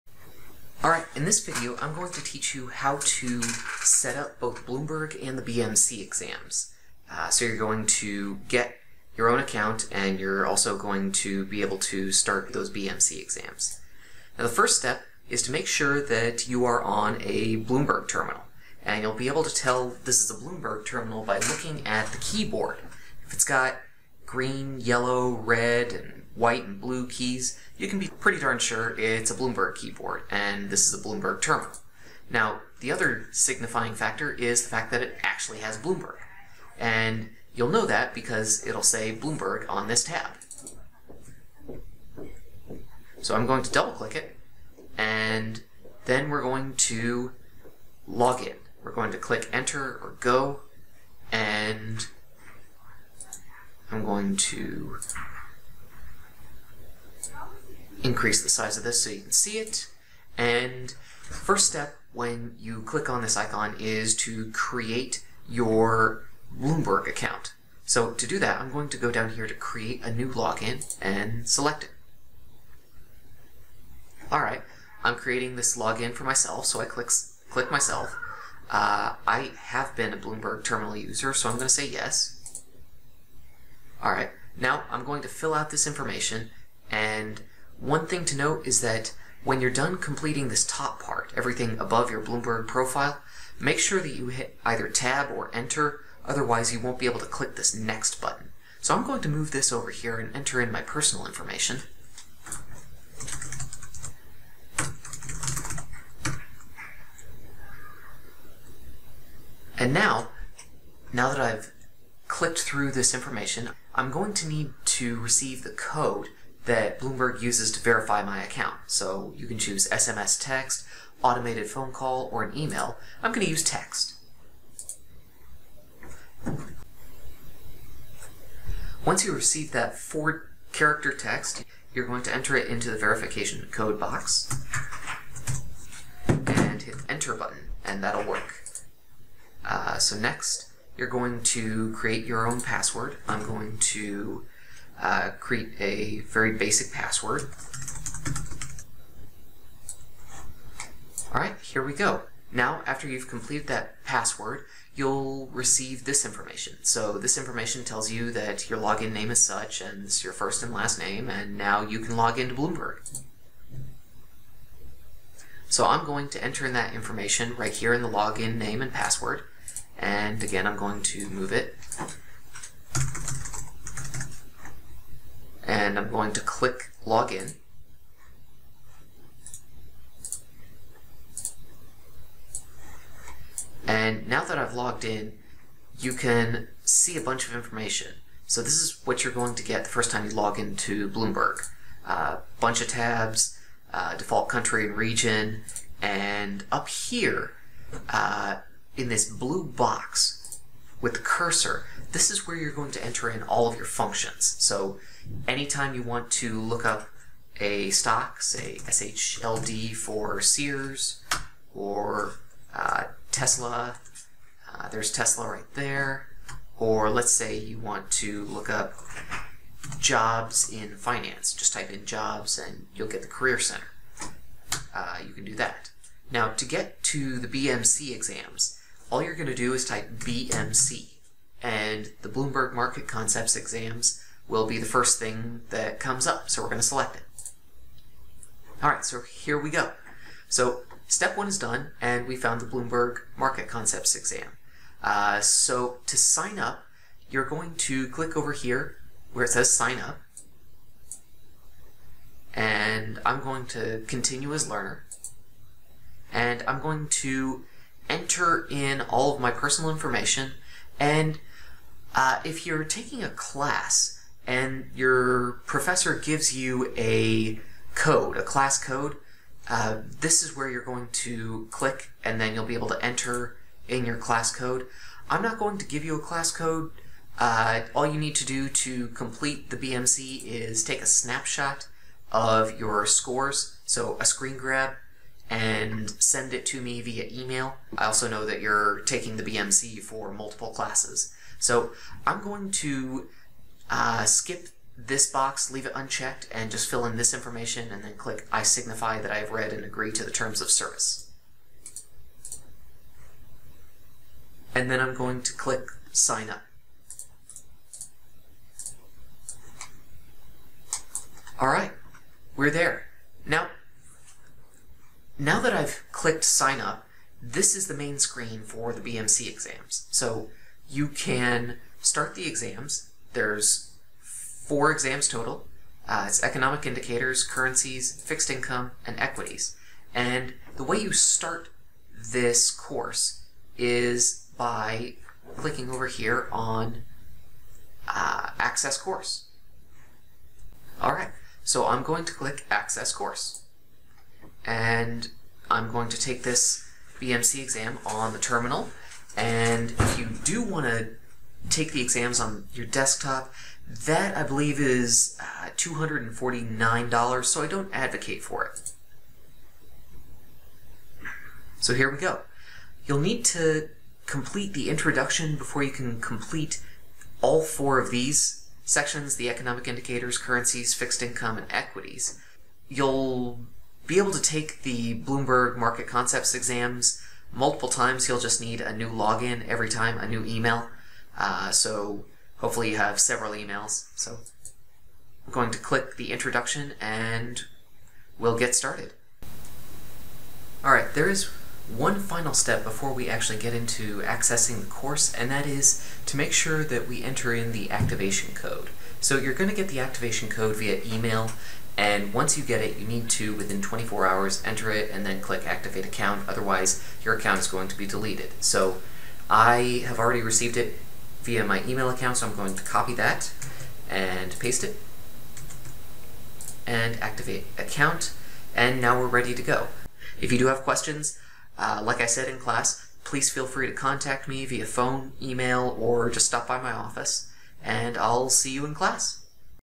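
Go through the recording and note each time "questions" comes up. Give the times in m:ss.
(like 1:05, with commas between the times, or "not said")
7:00.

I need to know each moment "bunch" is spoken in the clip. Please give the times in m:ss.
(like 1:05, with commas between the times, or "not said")
3:07, 3:12.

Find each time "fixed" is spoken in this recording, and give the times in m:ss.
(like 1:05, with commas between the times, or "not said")
5:28, 6:10.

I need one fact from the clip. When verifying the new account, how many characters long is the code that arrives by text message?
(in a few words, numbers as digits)
4.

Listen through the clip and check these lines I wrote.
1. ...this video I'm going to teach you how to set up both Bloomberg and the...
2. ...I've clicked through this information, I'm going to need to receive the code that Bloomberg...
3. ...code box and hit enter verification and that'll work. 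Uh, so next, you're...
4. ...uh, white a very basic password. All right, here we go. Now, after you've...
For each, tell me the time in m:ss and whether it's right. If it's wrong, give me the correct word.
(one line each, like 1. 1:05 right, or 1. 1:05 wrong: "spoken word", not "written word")
1. 0:01 right
2. 1:51 right
3. 2:13 wrong: "button", not "verification"
4. 2:25 wrong: "create", not "white".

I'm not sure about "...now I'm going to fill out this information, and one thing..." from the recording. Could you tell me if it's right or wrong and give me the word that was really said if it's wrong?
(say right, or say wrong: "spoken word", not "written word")
right.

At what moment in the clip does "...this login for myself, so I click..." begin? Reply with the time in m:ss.
1:15.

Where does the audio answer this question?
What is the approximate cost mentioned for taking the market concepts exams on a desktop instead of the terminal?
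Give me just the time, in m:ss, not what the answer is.
5:55.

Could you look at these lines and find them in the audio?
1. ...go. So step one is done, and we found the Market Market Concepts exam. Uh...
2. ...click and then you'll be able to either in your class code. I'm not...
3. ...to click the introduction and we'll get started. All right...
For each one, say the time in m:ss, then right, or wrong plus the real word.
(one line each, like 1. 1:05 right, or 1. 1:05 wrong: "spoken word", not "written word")
1. 3:59 wrong: "Bloomberg", not "Market"
2. 4:31 wrong: "enter", not "either"
3. 6:25 right.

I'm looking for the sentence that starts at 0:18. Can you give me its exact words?
And you'll be able to tell this is a Bloomberg terminal by looking at the keyboard.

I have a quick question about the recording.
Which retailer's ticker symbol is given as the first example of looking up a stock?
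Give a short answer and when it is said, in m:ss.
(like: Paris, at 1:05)
Sears, at 3:30.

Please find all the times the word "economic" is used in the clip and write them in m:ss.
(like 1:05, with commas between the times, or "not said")
5:26, 6:09.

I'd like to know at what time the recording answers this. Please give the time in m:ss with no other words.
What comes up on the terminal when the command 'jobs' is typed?
3:43.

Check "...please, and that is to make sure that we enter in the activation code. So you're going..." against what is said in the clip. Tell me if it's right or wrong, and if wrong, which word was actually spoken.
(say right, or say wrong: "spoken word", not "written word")
wrong: "course", not "please".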